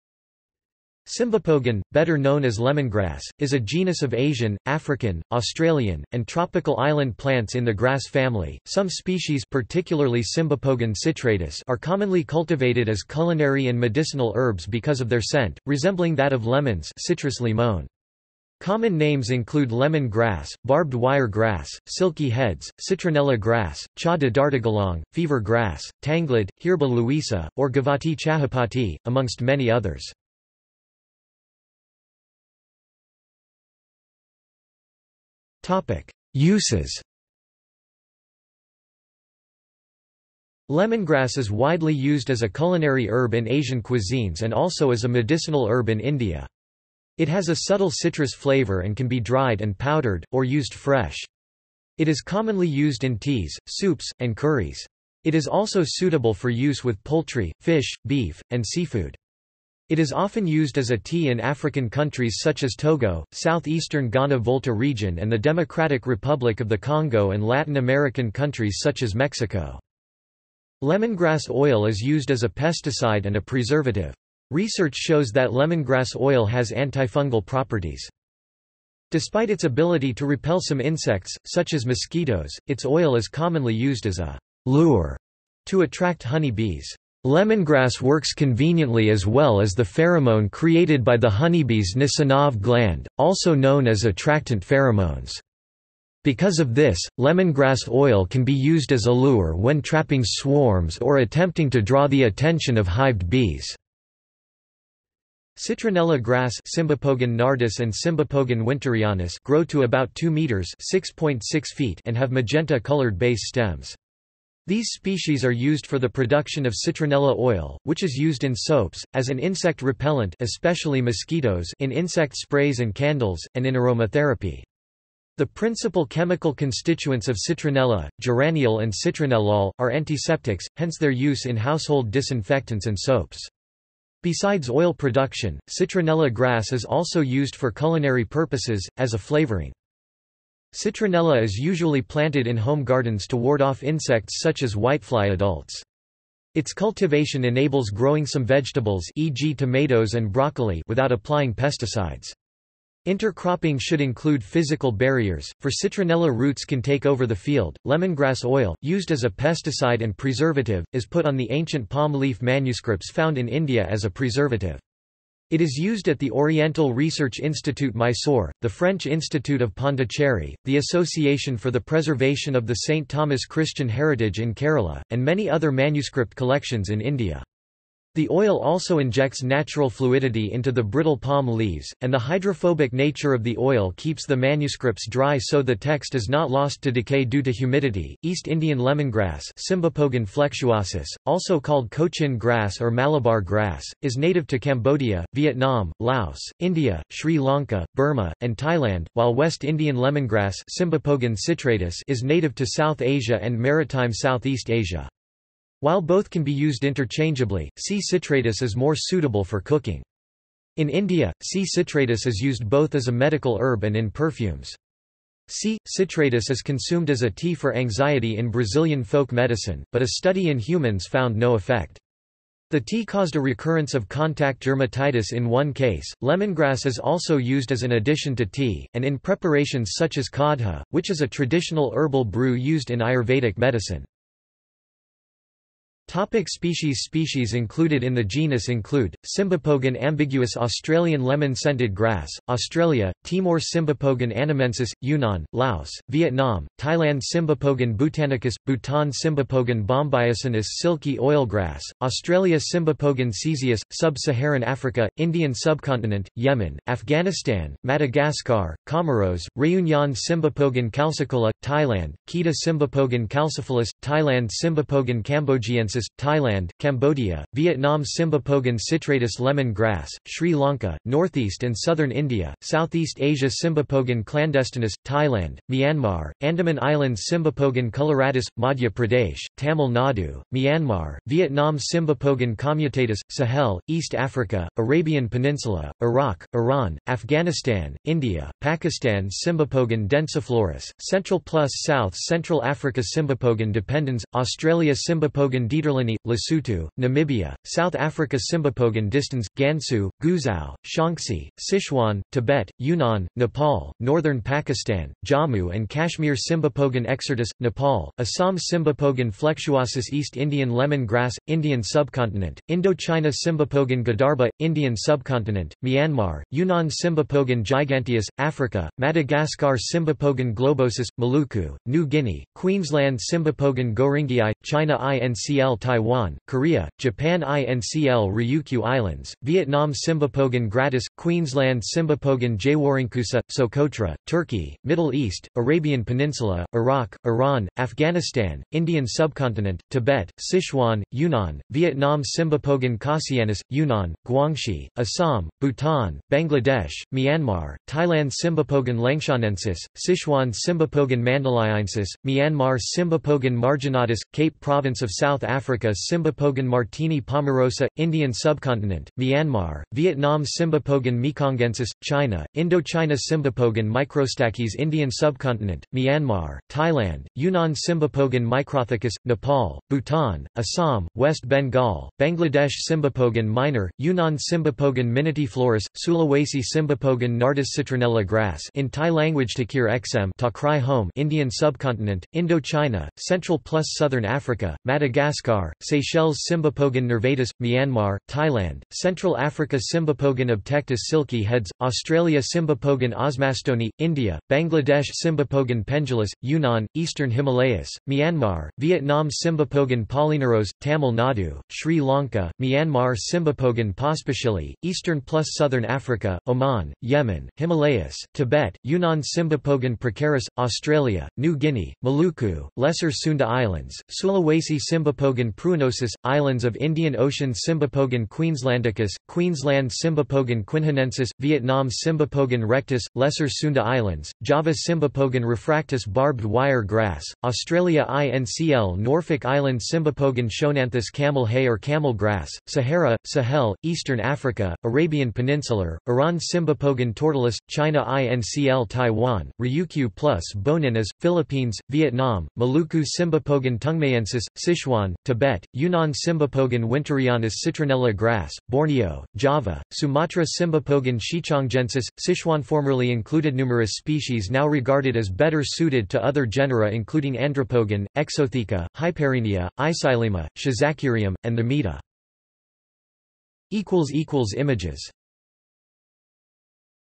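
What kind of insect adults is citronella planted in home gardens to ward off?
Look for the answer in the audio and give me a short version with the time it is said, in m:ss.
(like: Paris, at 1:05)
whitefly, at 2:24.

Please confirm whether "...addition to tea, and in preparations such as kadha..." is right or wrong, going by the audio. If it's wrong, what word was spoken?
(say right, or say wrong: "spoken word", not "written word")
right.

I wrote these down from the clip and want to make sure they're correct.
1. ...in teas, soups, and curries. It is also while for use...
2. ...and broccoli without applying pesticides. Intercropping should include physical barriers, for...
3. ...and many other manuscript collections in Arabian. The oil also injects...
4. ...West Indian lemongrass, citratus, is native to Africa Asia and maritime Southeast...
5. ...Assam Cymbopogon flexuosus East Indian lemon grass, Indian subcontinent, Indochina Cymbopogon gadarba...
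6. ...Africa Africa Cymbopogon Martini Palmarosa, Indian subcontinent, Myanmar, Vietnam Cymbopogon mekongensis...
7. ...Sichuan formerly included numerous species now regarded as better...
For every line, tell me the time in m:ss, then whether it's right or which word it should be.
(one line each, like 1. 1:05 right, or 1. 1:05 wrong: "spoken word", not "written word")
1. 0:53 wrong: "suitable", not "while"
2. 2:30 right
3. 2:55 wrong: "India", not "Arabian"
4. 3:19 wrong: "South", not "Africa"
5. 5:08 right
6. 5:55 right
7. 7:32 right.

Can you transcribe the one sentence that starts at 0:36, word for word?
Uses Lemongrass is widely used as a culinary herb in Asian cuisines and also as a medicinal herb in India.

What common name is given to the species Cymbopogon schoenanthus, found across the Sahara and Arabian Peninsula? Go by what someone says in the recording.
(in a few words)
camel hay.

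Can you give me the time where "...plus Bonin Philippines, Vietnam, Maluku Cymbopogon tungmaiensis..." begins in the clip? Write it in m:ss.
7:20.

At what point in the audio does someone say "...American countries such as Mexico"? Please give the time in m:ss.
1:07.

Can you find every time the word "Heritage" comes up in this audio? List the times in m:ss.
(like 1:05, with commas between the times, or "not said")
2:53.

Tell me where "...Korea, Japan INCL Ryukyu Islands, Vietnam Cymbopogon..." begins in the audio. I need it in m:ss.
5:26.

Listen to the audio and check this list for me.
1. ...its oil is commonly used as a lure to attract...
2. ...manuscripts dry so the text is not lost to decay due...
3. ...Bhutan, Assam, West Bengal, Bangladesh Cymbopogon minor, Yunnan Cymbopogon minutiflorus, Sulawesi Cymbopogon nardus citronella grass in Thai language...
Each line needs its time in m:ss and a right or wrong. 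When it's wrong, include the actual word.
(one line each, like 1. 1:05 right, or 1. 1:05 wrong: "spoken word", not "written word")
1. 1:22 right
2. 3:04 right
3. 6:09 right.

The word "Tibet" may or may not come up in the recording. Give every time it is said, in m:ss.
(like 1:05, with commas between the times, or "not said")
5:02, 5:39, 6:48, 7:25.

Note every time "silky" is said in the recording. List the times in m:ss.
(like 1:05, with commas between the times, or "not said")
0:21, 4:10, 6:31.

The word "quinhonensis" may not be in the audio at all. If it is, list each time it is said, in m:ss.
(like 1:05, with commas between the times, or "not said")
7:00.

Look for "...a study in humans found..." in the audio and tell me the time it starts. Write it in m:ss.
3:40.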